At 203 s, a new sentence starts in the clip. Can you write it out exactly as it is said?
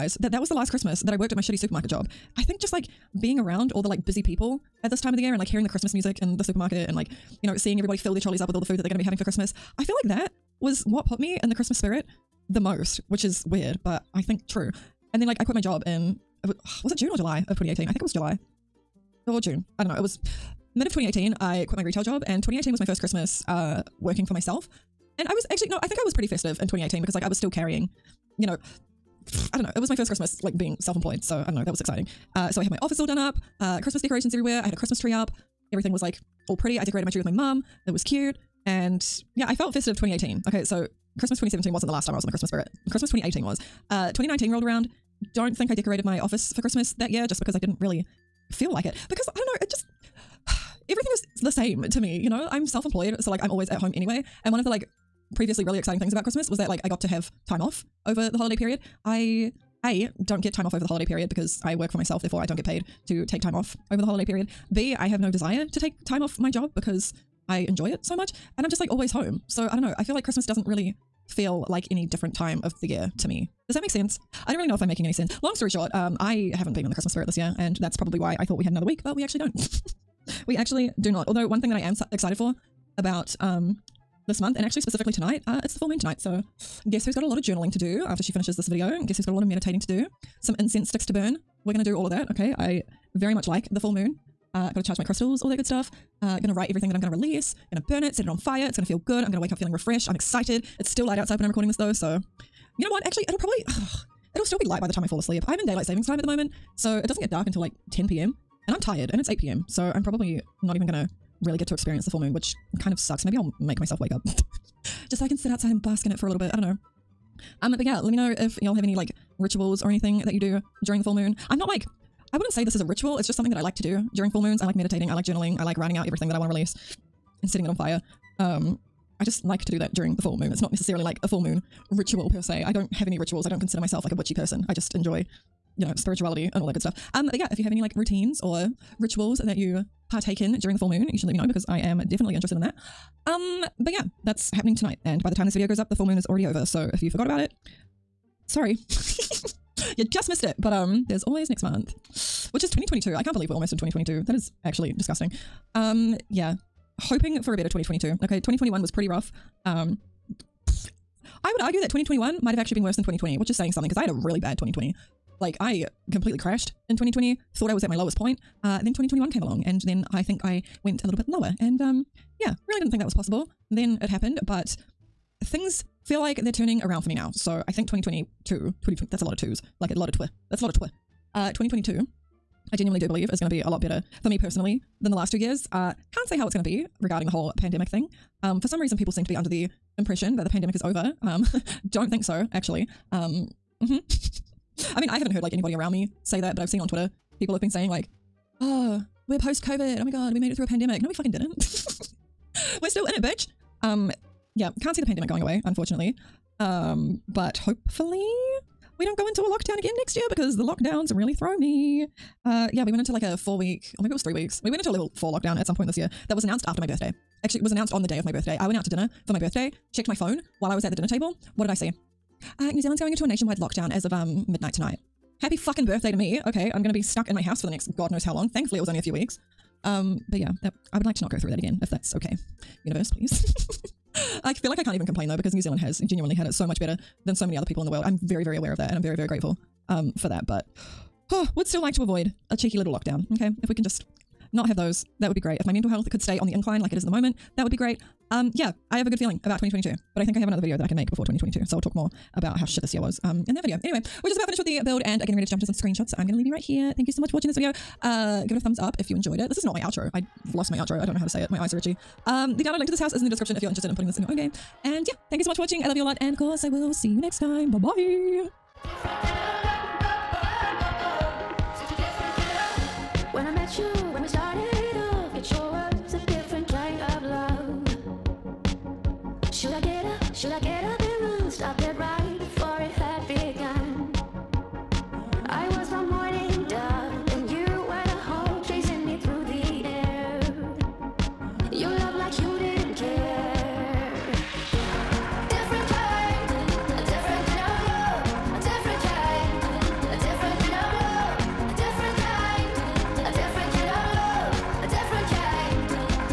Um, yeah, can't see the pandemic going away, unfortunately.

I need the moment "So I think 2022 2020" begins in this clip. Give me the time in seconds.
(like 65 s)
177 s.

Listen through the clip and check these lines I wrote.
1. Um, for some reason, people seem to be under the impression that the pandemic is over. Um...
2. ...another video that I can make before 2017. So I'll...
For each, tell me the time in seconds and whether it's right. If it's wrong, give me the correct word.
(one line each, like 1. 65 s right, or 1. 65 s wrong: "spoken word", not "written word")
1. 188 s right
2. 250 s wrong: "2022", not "2017".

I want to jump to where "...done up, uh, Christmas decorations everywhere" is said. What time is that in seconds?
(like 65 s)
33 s.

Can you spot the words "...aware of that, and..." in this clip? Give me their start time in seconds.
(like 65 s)
238 s.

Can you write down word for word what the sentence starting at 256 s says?
So I'm going to leave you right here.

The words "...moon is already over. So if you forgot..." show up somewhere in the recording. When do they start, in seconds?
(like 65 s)
146 s.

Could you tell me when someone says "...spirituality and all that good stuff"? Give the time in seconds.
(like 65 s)
135 s.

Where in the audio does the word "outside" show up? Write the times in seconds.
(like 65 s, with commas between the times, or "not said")
101 s, 115 s.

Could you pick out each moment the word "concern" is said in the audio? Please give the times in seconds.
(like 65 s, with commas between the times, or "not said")
not said.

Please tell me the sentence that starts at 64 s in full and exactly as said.
B I have no desire to take time off my job because I enjoy it so much.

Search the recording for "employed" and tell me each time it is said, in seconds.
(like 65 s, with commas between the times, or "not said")
30 s, 52 s.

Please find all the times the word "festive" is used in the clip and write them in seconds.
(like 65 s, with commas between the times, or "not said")
26 s, 39 s.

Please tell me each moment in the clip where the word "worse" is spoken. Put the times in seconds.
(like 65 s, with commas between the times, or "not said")
162 s.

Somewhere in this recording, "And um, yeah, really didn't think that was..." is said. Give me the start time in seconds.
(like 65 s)
171 s.